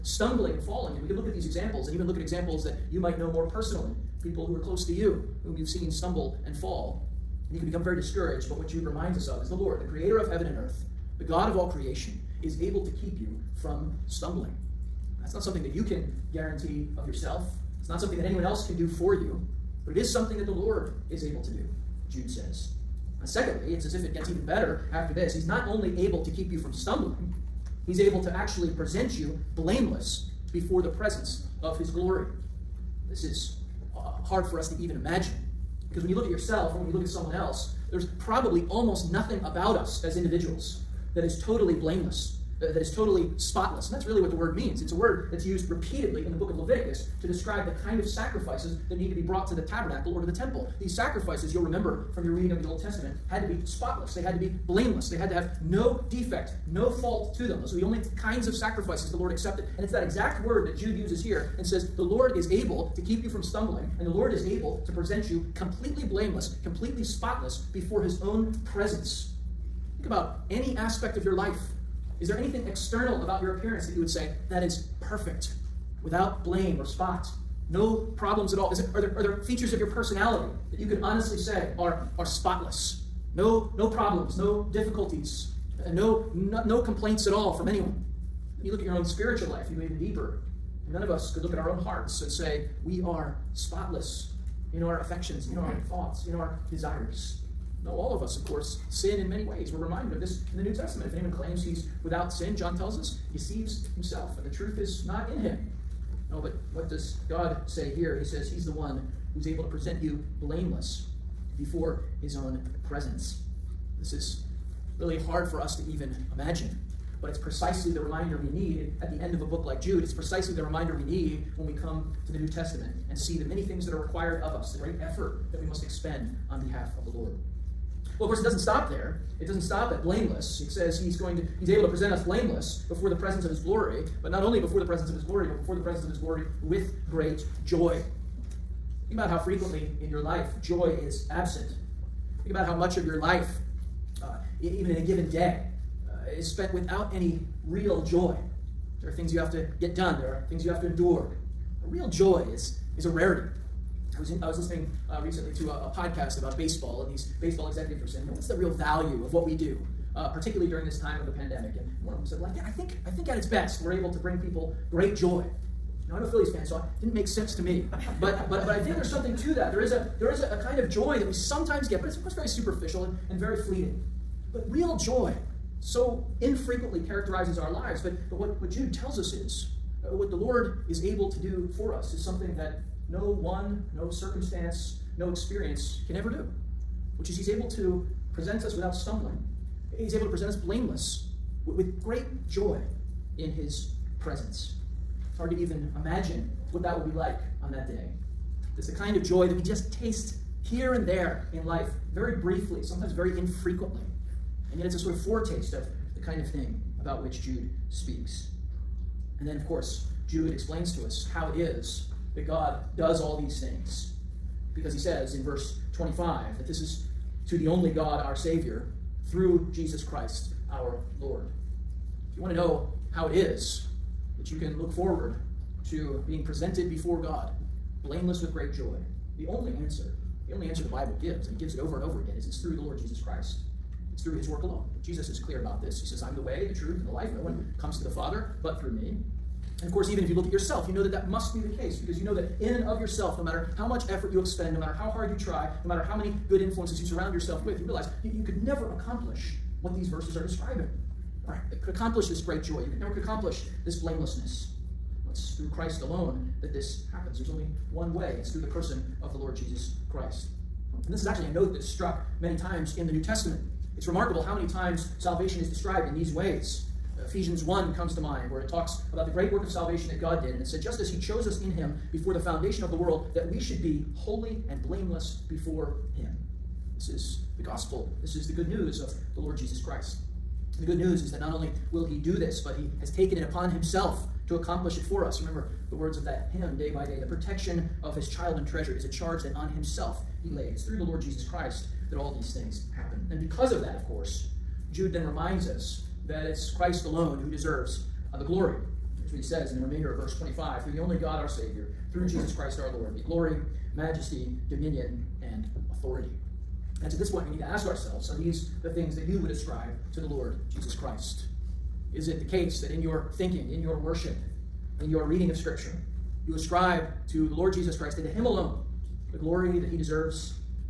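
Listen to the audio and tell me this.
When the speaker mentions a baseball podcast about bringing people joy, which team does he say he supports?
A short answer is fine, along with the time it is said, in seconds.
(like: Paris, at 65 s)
Phillies, at 166 s.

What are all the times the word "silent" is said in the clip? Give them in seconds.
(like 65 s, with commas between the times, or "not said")
not said.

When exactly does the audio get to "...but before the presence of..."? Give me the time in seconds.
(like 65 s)
135 s.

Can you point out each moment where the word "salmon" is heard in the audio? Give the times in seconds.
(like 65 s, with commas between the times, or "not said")
not said.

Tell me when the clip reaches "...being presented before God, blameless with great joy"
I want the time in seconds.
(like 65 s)
226 s.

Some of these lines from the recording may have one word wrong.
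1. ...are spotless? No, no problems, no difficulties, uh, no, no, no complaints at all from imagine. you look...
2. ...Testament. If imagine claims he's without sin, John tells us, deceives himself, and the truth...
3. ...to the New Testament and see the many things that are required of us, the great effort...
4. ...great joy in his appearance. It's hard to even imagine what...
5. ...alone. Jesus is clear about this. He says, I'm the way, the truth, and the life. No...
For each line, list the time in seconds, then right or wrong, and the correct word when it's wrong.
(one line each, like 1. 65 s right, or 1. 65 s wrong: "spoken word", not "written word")
1. 82 s wrong: "anyone", not "imagine"
2. 100 s wrong: "anyone", not "imagine"
3. 122 s right
4. 192 s wrong: "presence", not "appearance"
5. 234 s right.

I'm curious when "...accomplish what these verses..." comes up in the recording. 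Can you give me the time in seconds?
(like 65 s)
248 s.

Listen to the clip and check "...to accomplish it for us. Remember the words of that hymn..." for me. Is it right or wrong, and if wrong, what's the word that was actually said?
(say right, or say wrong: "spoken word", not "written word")
right.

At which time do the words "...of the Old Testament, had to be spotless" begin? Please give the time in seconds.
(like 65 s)
52 s.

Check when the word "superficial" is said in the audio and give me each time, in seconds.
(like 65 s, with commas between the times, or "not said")
172 s.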